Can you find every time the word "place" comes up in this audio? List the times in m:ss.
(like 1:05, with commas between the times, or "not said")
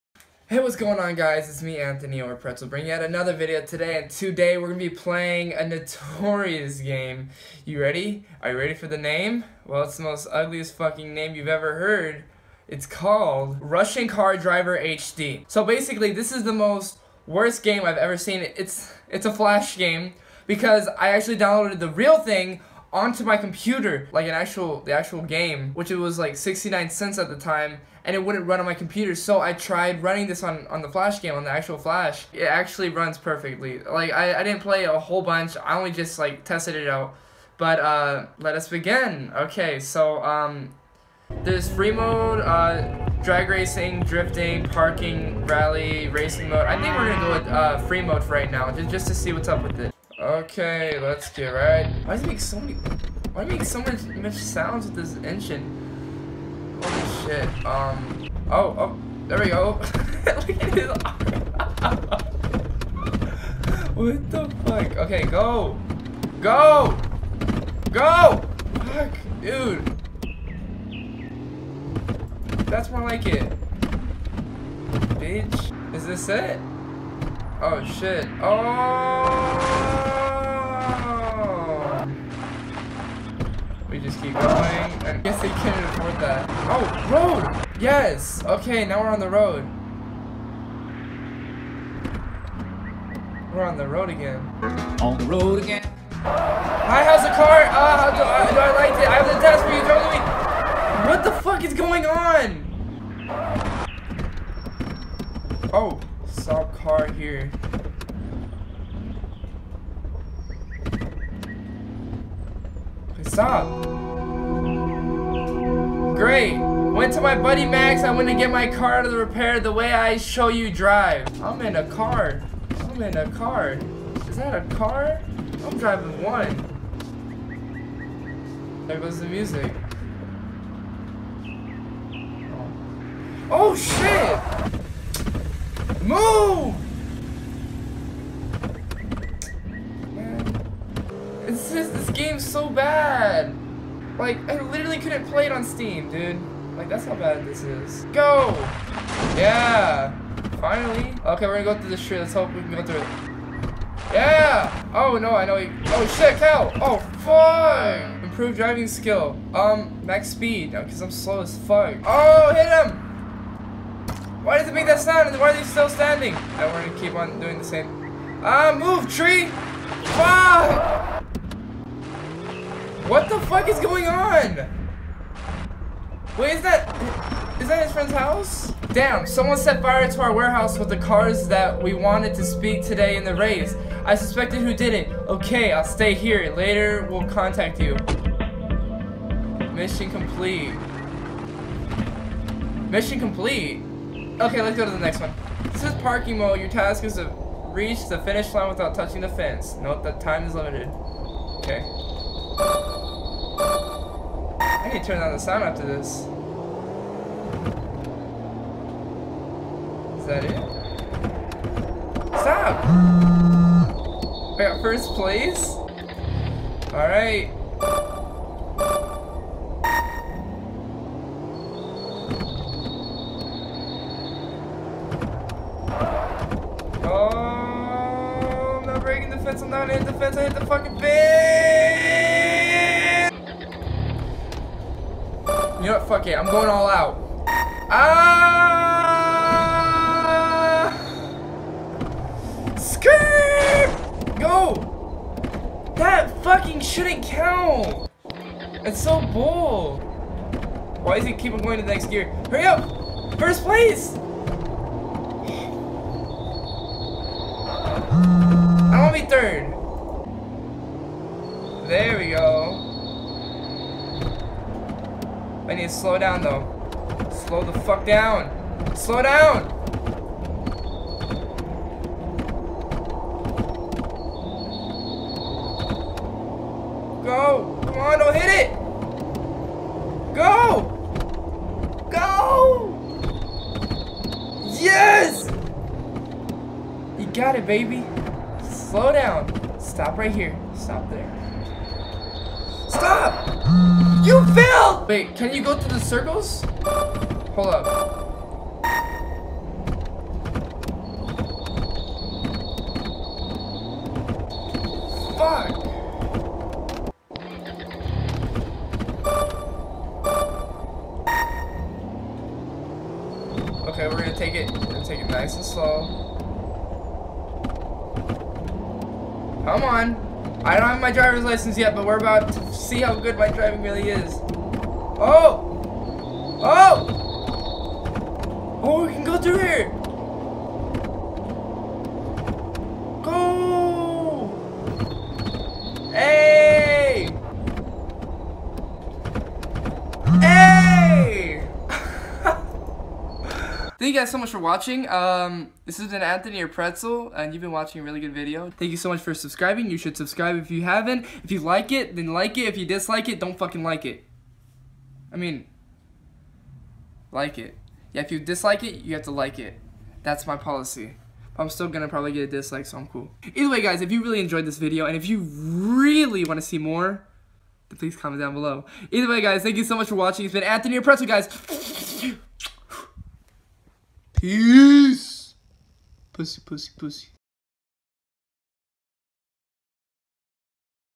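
3:35, 4:13.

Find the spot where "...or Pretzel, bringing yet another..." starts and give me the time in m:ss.
0:02.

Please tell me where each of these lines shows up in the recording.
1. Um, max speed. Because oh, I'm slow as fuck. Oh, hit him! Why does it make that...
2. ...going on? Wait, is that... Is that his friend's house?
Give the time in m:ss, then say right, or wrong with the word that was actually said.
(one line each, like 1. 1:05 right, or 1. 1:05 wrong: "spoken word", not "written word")
1. 2:39 right
2. 2:53 right.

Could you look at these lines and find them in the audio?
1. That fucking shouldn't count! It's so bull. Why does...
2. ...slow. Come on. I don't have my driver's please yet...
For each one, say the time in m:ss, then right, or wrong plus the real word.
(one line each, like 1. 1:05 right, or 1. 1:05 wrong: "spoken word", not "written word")
1. 4:05 right
2. 5:15 wrong: "license", not "please".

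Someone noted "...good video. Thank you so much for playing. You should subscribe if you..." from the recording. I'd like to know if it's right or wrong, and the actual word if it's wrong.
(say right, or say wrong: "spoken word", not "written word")
wrong: "subscribing", not "playing".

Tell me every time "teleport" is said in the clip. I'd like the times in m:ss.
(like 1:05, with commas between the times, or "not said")
not said.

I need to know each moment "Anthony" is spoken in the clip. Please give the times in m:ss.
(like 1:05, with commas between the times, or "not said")
0:01, 5:46, 6:10.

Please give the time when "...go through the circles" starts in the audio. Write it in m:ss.
4:55.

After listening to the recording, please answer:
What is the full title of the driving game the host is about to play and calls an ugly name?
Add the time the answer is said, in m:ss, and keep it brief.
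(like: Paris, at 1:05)
Russian Car Driver HD, at 0:13.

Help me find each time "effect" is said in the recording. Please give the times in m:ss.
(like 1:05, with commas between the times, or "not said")
not said.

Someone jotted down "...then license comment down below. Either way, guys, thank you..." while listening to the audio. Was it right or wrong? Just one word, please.
wrong.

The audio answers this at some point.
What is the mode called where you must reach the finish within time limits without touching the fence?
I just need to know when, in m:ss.
3:15.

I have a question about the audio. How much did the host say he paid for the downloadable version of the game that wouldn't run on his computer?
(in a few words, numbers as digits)
69 cents.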